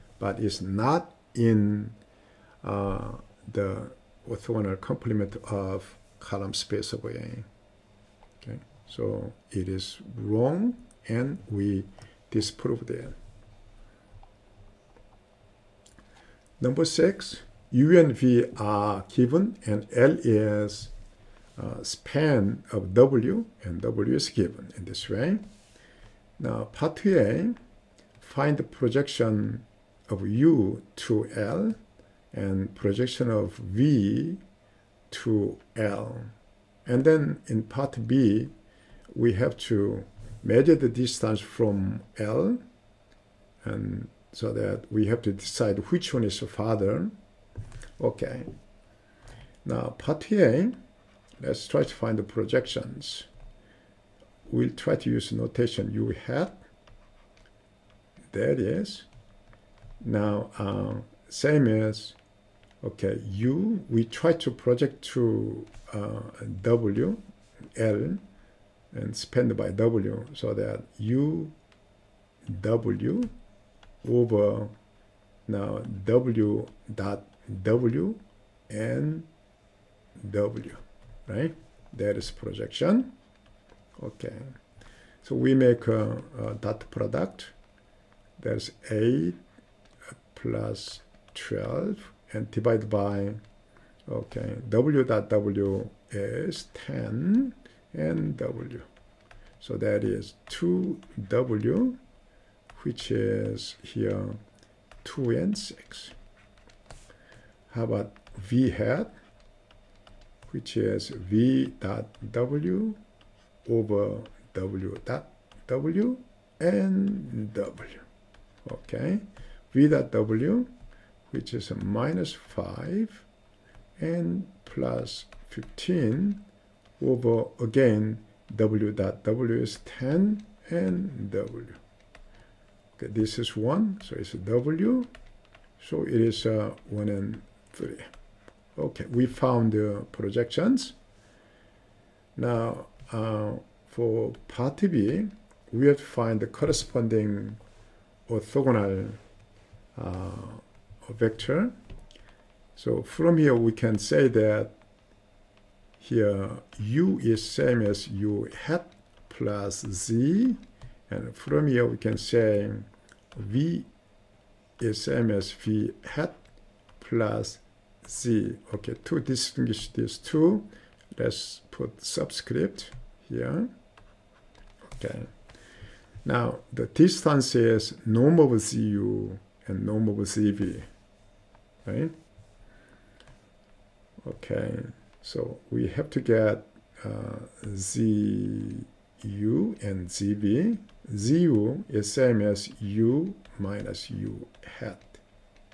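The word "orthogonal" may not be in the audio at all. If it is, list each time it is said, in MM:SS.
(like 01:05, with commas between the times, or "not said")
00:04, 02:28.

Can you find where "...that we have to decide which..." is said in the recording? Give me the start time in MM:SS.
00:44.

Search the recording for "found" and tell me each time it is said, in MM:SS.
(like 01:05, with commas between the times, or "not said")
02:19.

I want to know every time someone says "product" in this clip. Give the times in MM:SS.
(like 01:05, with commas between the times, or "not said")
01:26.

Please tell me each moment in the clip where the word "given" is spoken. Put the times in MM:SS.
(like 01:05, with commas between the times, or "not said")
00:19, 00:24.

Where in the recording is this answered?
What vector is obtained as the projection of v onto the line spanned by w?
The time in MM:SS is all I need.
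02:16.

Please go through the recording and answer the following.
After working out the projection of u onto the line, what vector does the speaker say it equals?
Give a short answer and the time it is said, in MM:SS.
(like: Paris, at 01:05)
2 and 6, at 01:45.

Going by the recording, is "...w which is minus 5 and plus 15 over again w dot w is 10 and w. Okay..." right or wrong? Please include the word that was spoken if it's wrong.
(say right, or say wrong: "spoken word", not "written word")
right.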